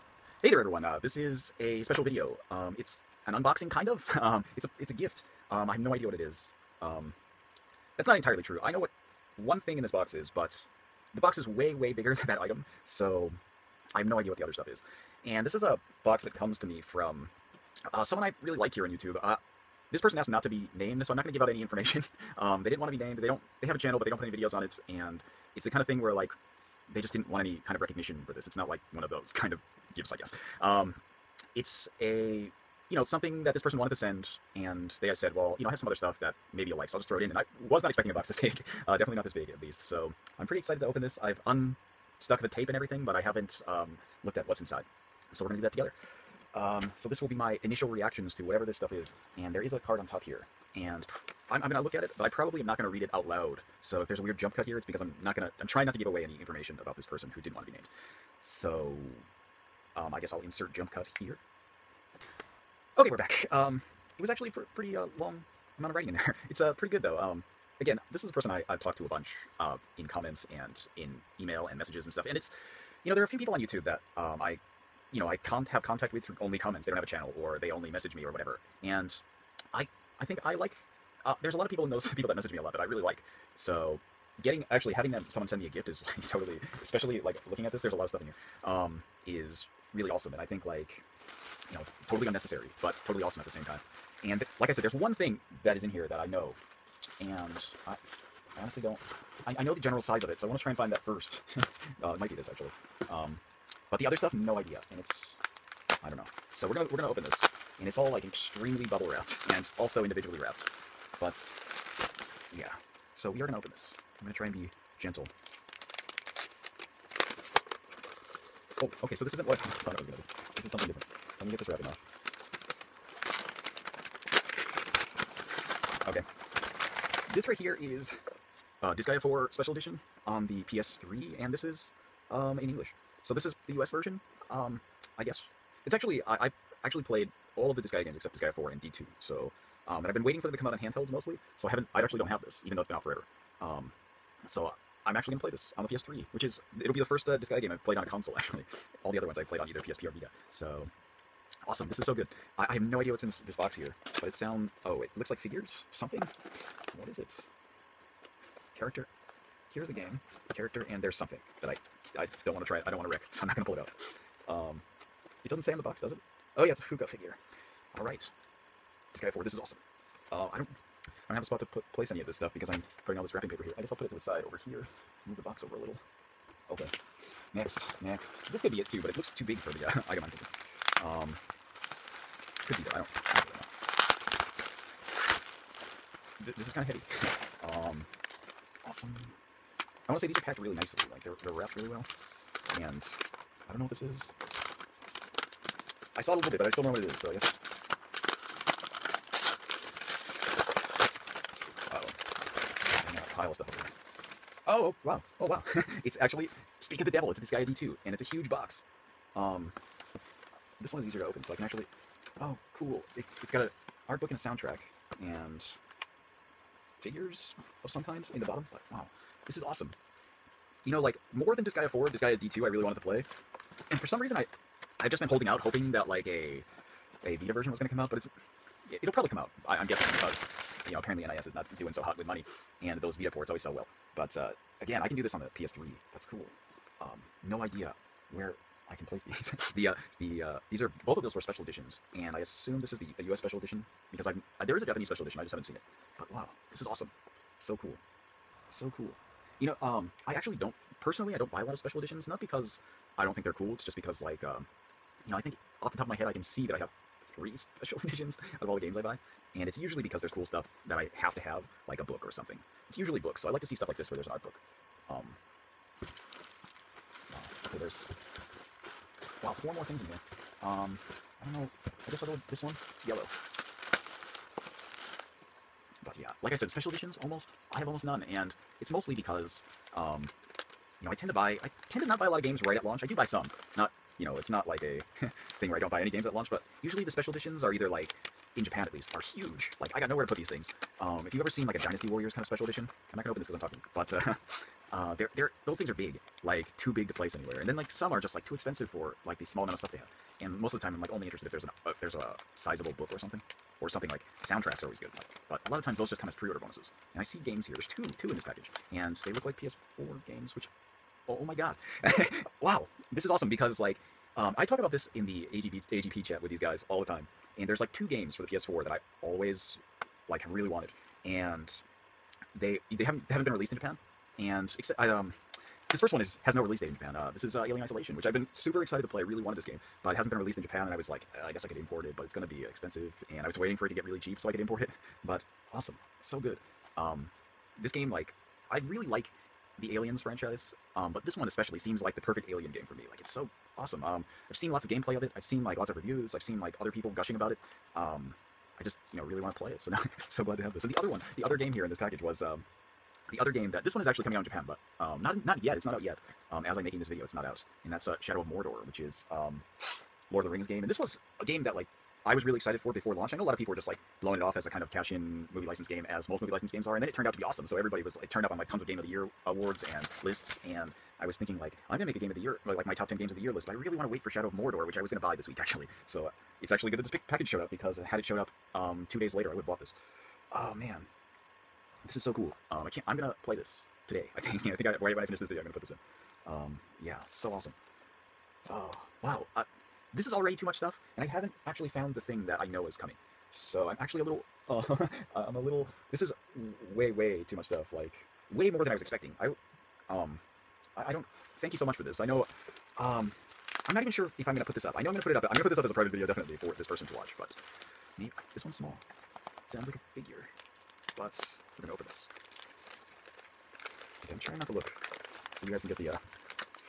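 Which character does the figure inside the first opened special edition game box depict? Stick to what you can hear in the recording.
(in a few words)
Fuka.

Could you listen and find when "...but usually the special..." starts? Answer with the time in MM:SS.
04:46.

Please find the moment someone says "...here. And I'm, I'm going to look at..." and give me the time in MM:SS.
00:50.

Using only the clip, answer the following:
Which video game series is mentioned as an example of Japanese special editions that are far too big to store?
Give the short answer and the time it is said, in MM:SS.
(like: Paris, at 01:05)
Dynasty Warriors, at 04:51.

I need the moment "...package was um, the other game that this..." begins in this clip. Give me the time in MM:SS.
05:51.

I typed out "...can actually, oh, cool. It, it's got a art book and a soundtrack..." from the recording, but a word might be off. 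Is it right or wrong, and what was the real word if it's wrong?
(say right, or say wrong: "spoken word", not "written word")
right.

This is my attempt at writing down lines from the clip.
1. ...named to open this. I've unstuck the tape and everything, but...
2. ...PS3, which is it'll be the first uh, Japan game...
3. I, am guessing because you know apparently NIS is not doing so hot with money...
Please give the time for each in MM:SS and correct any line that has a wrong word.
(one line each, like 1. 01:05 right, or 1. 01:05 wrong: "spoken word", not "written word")
1. 00:40 wrong: "excited", not "named"
2. 02:25 wrong: "Disgaea", not "Japan"
3. 03:49 right.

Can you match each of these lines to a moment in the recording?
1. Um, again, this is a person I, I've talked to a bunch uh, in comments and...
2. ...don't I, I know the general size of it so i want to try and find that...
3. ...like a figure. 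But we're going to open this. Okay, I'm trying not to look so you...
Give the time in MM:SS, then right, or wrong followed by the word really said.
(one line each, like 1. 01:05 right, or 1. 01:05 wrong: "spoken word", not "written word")
1. 01:07 right
2. 01:38 right
3. 06:49 right.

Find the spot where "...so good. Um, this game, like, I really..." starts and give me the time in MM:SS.
05:36.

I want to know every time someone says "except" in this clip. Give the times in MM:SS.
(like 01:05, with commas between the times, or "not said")
02:18, 05:24.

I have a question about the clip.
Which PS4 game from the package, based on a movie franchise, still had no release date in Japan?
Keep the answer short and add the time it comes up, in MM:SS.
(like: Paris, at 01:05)
Alien Isolation, at 05:27.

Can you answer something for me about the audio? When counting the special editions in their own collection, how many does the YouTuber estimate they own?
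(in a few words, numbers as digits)
3.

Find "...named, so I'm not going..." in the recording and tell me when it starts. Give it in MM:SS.
00:20.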